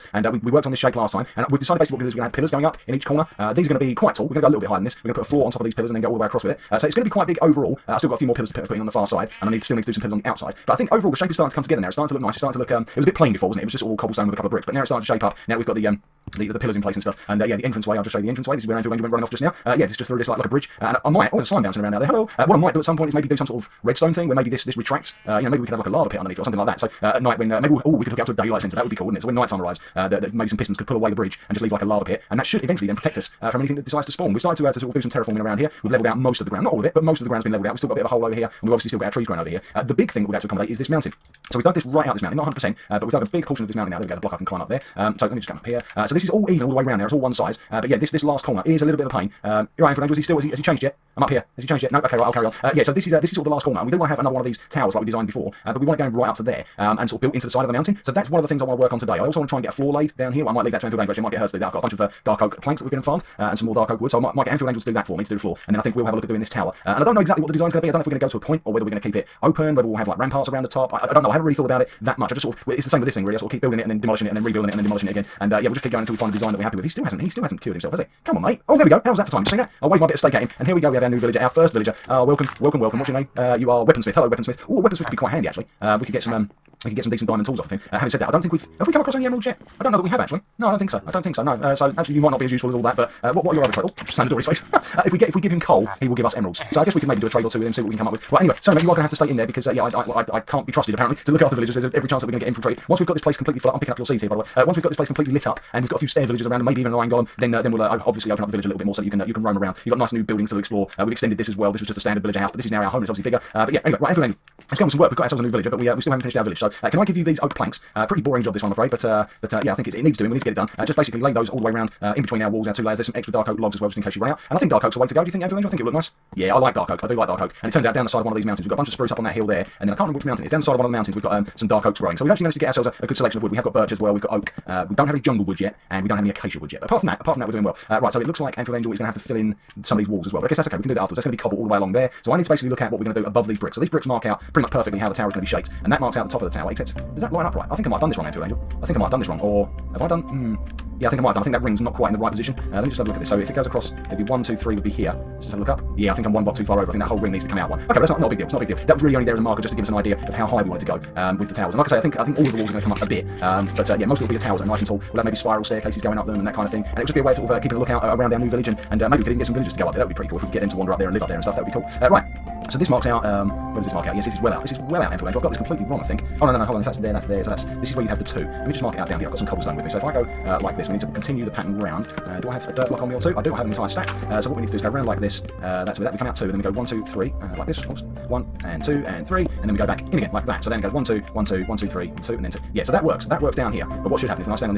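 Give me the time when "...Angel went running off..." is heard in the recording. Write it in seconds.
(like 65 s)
18 s.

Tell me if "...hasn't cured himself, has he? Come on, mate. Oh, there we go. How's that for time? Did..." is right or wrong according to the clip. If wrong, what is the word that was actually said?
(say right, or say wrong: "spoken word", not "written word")
right.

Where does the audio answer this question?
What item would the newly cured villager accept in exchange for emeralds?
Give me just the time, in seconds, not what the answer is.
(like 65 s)
95 s.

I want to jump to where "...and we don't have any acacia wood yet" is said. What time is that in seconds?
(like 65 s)
135 s.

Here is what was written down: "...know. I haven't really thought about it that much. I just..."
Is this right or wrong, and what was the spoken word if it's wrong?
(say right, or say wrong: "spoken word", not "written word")
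right.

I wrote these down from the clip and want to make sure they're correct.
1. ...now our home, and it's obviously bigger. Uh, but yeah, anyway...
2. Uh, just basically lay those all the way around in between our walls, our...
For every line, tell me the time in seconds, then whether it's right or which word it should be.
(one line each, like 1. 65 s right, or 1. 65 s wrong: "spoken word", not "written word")
1. 112 s right
2. 120 s right.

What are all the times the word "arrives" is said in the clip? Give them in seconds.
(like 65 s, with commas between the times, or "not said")
29 s.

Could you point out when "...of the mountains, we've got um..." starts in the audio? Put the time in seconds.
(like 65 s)
130 s.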